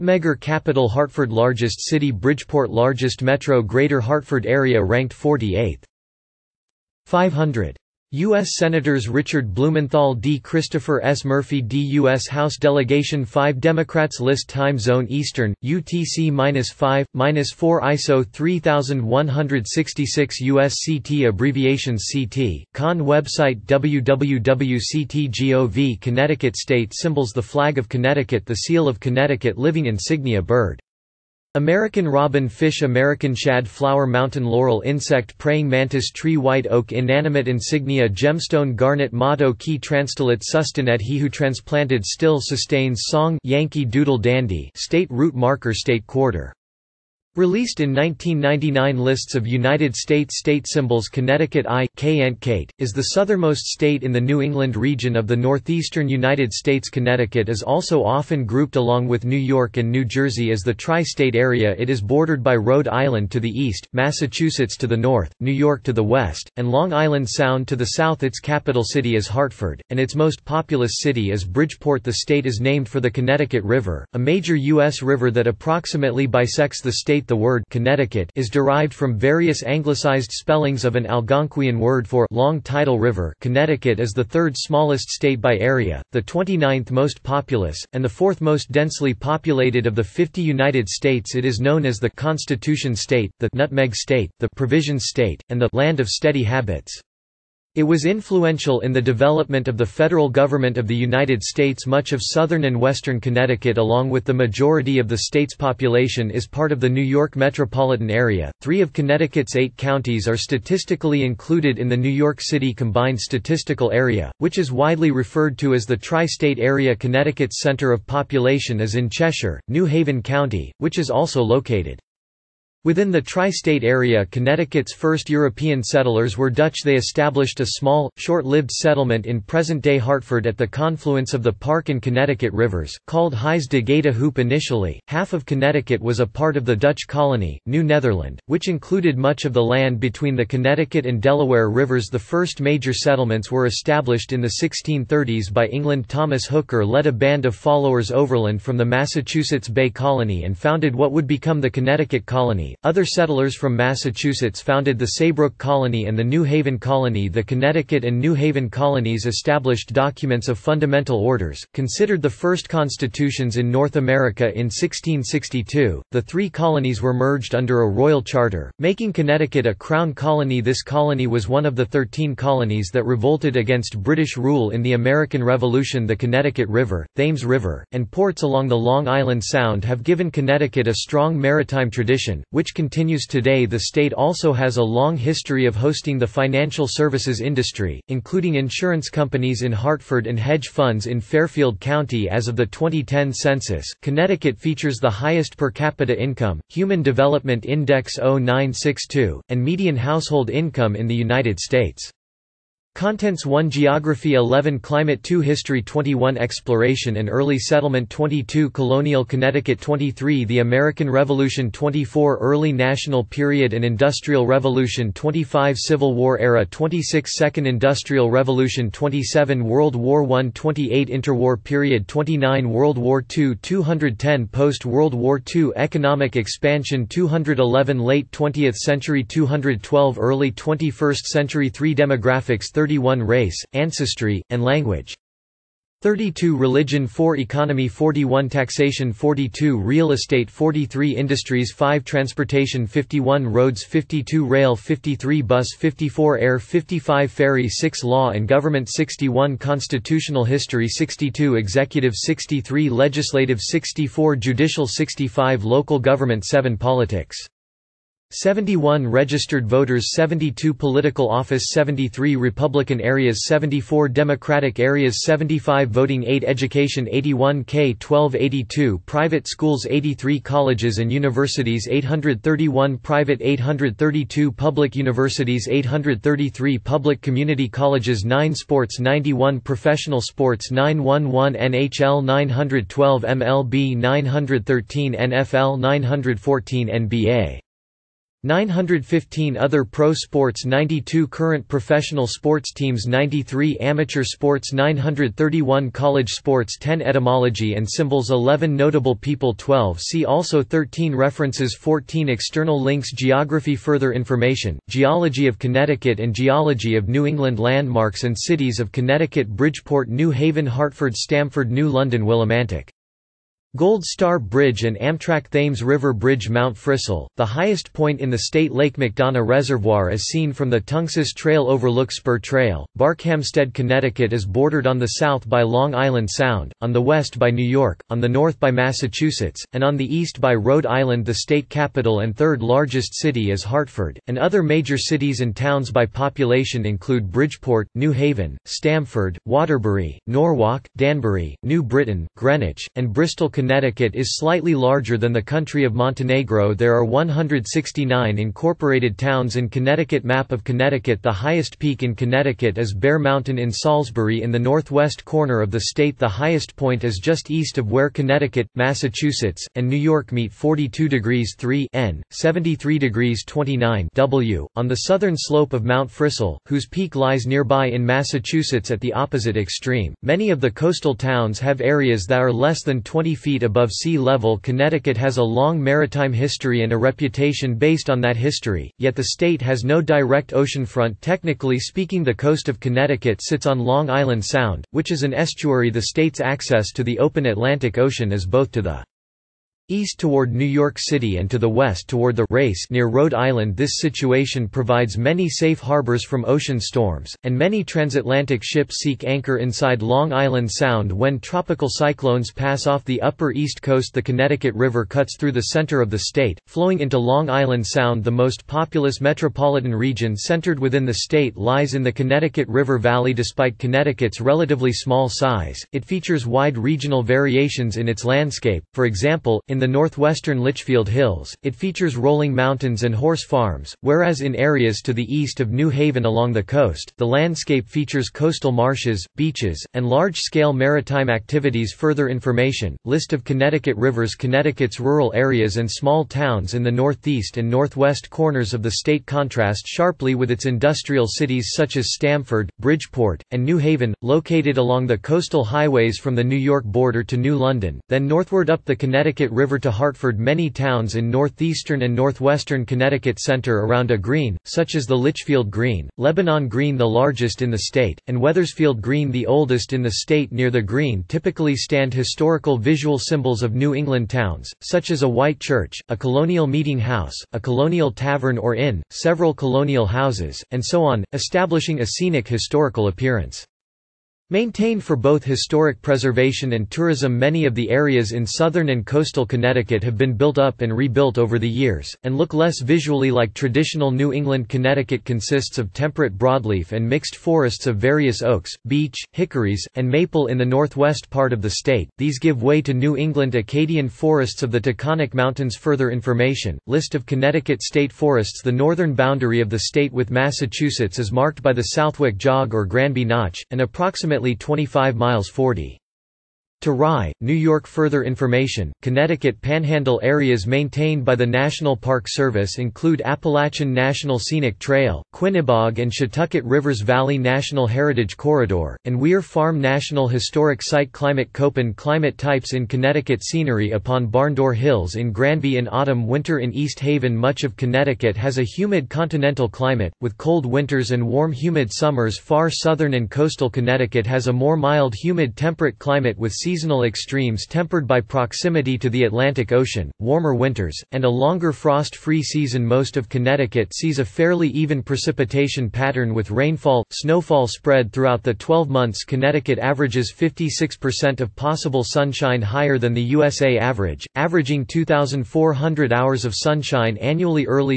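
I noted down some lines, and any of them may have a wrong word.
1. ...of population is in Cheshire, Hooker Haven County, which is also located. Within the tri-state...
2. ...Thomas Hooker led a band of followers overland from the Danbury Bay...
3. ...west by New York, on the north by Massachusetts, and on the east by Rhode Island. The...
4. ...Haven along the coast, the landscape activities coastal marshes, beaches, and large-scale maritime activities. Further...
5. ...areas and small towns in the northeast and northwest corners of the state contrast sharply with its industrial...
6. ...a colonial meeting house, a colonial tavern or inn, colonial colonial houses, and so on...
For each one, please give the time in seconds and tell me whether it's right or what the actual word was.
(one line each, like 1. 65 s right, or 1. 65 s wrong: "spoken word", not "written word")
1. 117 s wrong: "New", not "Hooker"
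2. 146 s wrong: "Massachusetts", not "Danbury"
3. 327 s right
4. 425 s wrong: "features", not "activities"
5. 435 s right
6. 466 s wrong: "several", not "colonial".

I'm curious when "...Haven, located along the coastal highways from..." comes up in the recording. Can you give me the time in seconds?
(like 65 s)
443 s.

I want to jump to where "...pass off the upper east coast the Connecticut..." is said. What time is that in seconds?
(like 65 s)
402 s.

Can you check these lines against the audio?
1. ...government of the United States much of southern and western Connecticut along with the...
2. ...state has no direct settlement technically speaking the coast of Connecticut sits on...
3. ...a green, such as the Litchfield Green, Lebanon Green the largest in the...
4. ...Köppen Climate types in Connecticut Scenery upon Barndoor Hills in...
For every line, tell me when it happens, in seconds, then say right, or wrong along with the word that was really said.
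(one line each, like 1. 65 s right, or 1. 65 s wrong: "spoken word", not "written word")
1. 100 s right
2. 379 s wrong: "oceanfront", not "settlement"
3. 454 s right
4. 521 s right.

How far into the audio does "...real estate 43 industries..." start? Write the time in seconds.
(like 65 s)
239 s.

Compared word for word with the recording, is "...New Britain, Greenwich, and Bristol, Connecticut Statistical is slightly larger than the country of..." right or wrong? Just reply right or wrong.
wrong.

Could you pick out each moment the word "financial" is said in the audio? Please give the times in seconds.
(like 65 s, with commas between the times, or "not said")
186 s.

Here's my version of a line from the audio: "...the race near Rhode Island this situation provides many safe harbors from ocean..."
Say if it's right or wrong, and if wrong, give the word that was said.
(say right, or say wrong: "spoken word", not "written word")
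right.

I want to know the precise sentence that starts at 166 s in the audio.
The three colonies were merged under a royal charter, making Connecticut a crown colony.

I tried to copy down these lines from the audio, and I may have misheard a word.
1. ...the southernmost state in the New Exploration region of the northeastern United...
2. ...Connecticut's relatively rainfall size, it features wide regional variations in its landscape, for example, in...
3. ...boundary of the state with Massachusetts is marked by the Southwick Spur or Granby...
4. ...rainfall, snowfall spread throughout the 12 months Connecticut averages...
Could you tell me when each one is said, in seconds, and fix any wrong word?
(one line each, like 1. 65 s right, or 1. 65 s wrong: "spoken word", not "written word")
1. 52 s wrong: "England", not "Exploration"
2. 413 s wrong: "small", not "rainfall"
3. 499 s wrong: "Jog", not "Spur"
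4. 546 s right.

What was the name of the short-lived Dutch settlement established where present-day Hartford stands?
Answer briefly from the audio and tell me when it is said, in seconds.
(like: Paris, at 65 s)
Huys de Goede Hoop, at 133 s.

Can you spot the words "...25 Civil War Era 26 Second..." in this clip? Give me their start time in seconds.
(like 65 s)
215 s.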